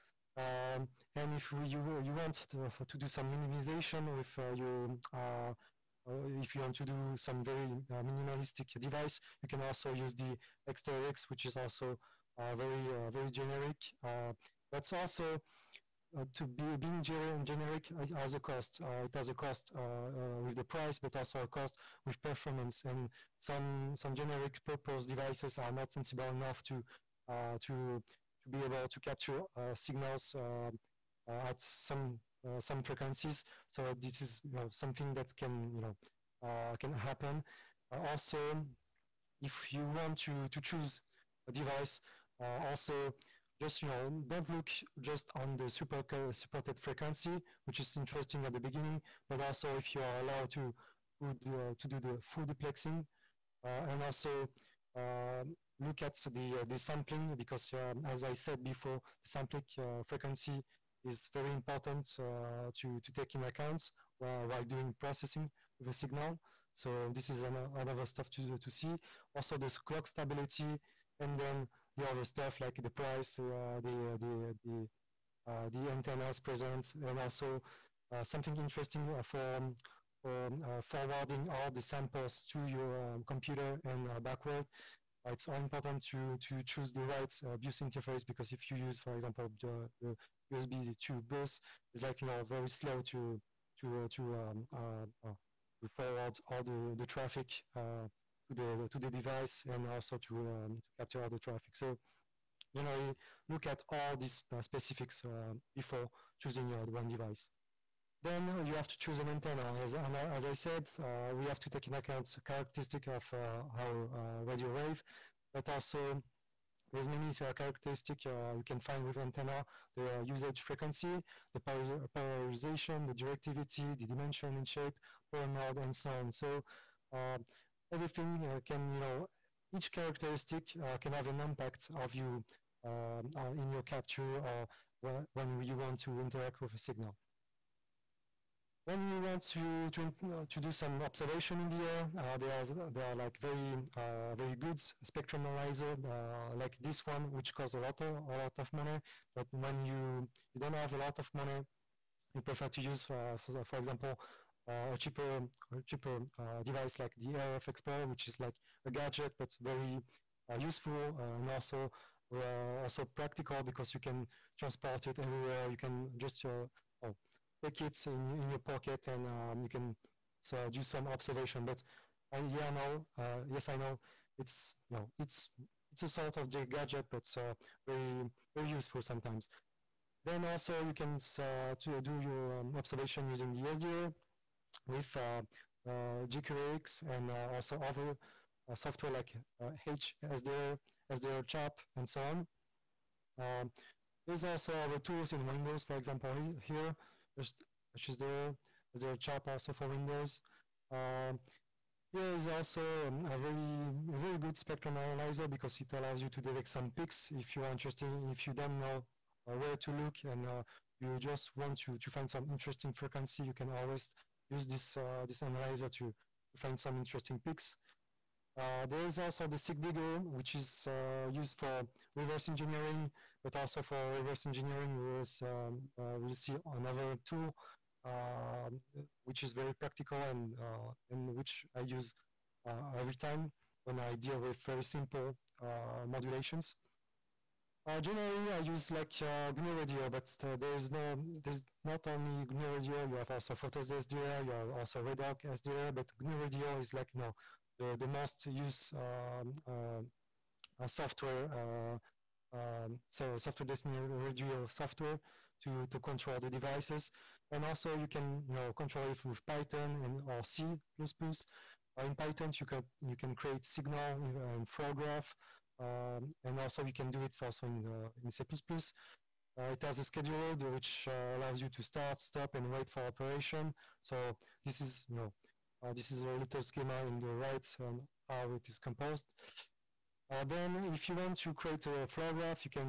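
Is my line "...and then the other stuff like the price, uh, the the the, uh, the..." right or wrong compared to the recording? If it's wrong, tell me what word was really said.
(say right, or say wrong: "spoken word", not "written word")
right.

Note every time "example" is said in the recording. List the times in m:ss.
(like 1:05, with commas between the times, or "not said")
1:29, 2:33, 3:15.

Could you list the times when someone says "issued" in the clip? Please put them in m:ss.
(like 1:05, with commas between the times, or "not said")
not said.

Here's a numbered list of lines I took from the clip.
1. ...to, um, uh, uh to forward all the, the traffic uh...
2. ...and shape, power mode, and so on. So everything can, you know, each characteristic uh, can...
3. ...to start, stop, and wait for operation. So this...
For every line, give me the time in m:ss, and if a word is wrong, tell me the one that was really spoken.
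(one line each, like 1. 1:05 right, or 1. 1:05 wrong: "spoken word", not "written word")
1. 1:34 right
2. 2:04 right
3. 4:31 right.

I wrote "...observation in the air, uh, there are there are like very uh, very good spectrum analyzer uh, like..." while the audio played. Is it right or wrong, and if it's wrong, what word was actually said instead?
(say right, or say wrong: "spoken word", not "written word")
right.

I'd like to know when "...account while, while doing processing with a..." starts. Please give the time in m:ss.
1:03.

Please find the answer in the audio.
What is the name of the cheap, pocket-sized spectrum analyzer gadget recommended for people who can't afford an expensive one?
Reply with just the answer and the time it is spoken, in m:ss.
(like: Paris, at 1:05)
RF Explorer, at 2:37.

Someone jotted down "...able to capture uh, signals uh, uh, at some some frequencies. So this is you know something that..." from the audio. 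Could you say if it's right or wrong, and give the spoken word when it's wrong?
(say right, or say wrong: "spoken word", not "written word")
right.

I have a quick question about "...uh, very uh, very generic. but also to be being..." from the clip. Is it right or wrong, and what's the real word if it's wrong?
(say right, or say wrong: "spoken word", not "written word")
right.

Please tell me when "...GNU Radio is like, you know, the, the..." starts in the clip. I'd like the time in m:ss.
4:06.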